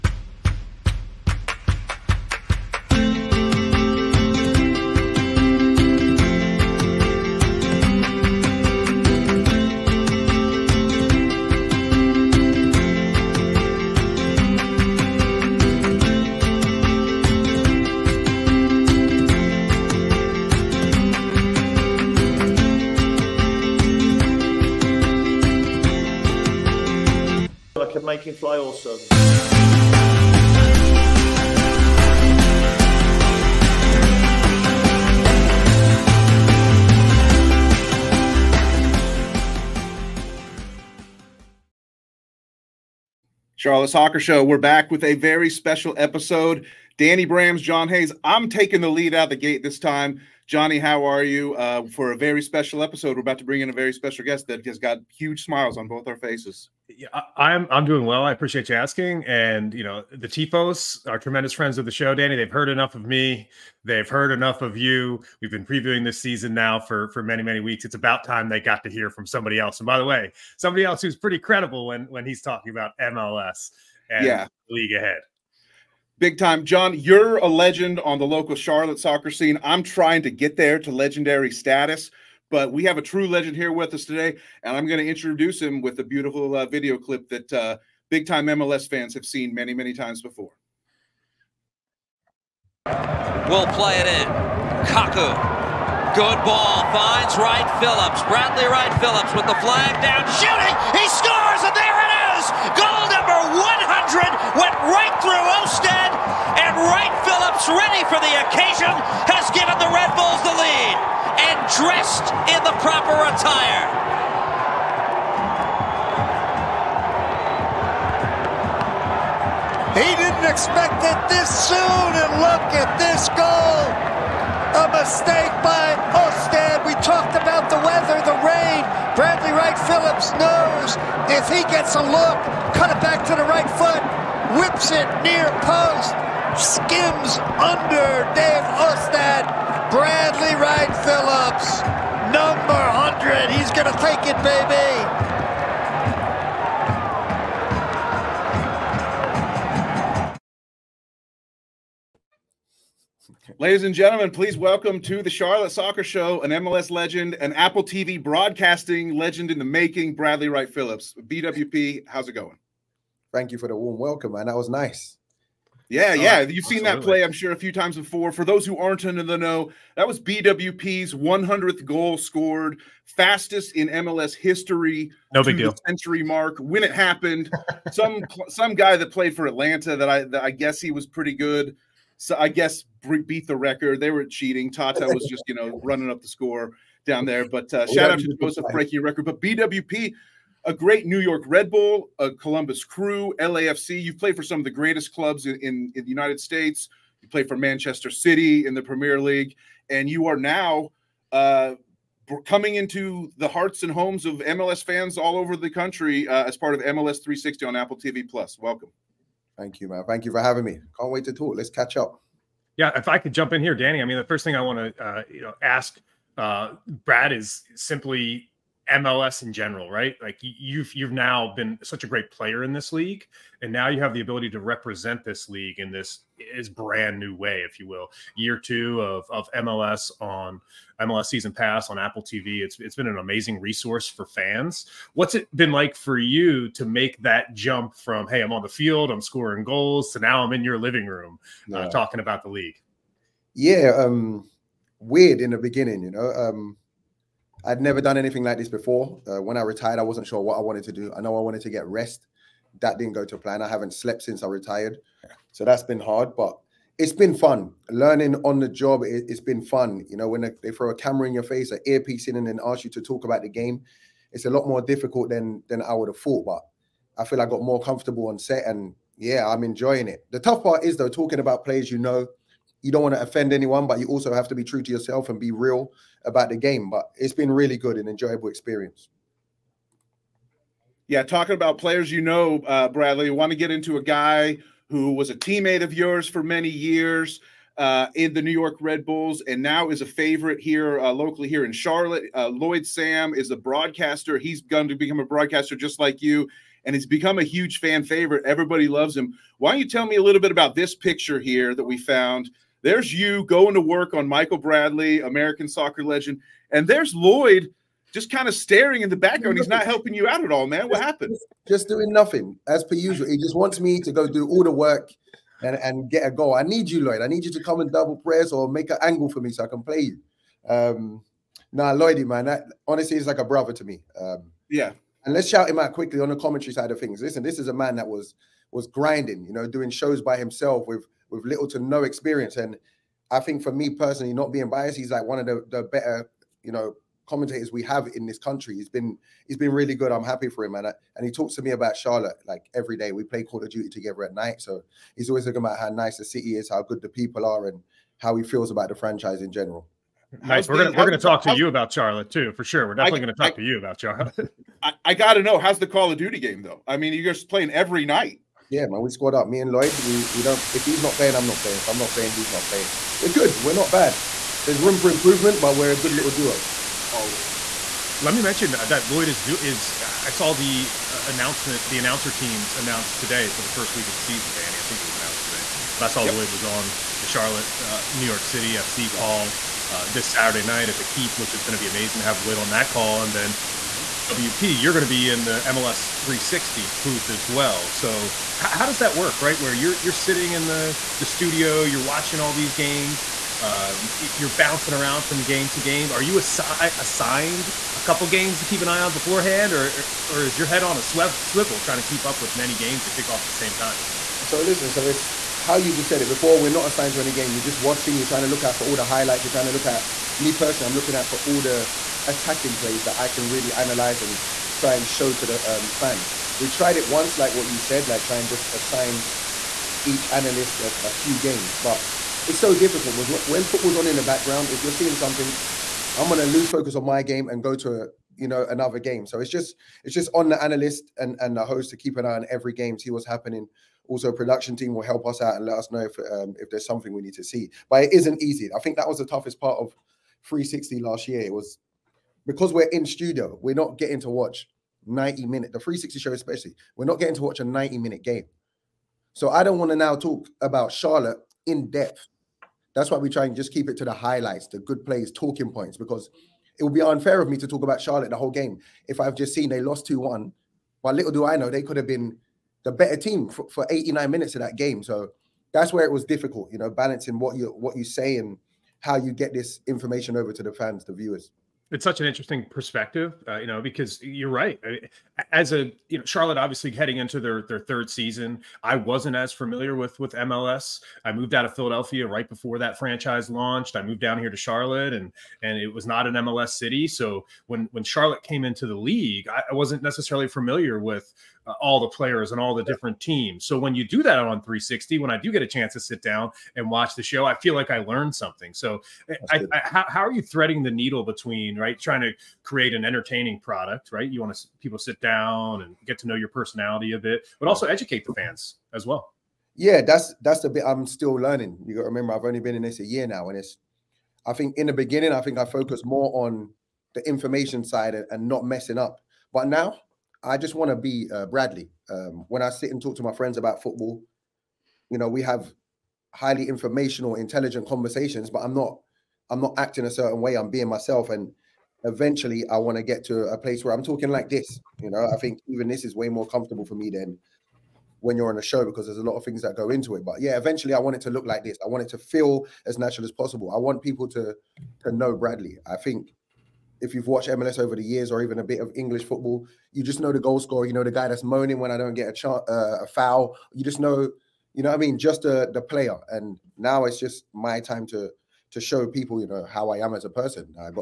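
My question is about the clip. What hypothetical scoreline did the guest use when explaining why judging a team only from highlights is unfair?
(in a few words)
2-1.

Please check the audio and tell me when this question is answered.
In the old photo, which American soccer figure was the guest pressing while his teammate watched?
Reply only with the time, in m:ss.
5:04.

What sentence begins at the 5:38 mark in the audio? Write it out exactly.
He's been he's been really good.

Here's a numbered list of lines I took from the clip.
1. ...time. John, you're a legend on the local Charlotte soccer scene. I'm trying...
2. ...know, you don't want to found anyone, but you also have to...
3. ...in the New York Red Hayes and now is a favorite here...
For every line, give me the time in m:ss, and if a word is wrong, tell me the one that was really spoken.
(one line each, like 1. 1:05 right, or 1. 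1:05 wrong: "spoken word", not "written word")
1. 1:16 right
2. 4:31 wrong: "offend", not "found"
3. 4:48 wrong: "Bulls", not "Hayes".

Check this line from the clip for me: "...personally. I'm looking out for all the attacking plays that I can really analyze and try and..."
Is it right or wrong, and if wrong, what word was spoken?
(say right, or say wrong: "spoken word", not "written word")
right.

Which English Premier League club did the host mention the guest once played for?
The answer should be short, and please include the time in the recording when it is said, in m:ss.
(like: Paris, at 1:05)
Manchester City, at 3:17.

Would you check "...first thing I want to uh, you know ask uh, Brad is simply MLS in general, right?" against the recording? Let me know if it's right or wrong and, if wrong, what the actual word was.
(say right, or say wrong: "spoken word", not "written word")
right.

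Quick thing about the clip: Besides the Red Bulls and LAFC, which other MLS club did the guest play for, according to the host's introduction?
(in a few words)
Columbus Crew.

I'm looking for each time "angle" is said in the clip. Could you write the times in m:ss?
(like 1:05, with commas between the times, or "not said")
5:19.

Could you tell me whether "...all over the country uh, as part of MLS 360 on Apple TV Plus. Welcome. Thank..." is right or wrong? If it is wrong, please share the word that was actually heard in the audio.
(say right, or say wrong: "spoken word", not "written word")
right.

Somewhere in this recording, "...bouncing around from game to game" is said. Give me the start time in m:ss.
6:34.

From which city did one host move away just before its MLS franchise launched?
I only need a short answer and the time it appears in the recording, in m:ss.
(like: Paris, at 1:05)
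Philadelphia, at 8:01.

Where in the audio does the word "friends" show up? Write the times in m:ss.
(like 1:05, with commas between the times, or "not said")
1:01, 8:43.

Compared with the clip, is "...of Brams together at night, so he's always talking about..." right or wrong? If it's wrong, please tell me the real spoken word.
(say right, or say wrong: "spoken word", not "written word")
wrong: "Duty", not "Brams".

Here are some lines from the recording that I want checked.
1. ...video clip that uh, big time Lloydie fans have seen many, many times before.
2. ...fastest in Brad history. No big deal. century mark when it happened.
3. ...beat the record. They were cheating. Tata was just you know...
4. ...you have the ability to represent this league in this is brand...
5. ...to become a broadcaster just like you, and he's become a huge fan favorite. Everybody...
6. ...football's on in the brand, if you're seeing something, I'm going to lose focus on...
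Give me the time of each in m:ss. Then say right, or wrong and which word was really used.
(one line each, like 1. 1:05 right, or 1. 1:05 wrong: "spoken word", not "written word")
1. 1:26 wrong: "MLS", not "Lloydie"
2. 2:53 wrong: "MLS", not "Brad"
3. 3:03 right
4. 3:43 right
5. 4:54 right
6. 7:03 wrong: "background", not "brand".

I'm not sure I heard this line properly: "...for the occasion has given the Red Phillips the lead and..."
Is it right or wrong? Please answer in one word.
wrong.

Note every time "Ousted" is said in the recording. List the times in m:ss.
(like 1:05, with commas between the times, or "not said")
1:45, 2:06, 2:18.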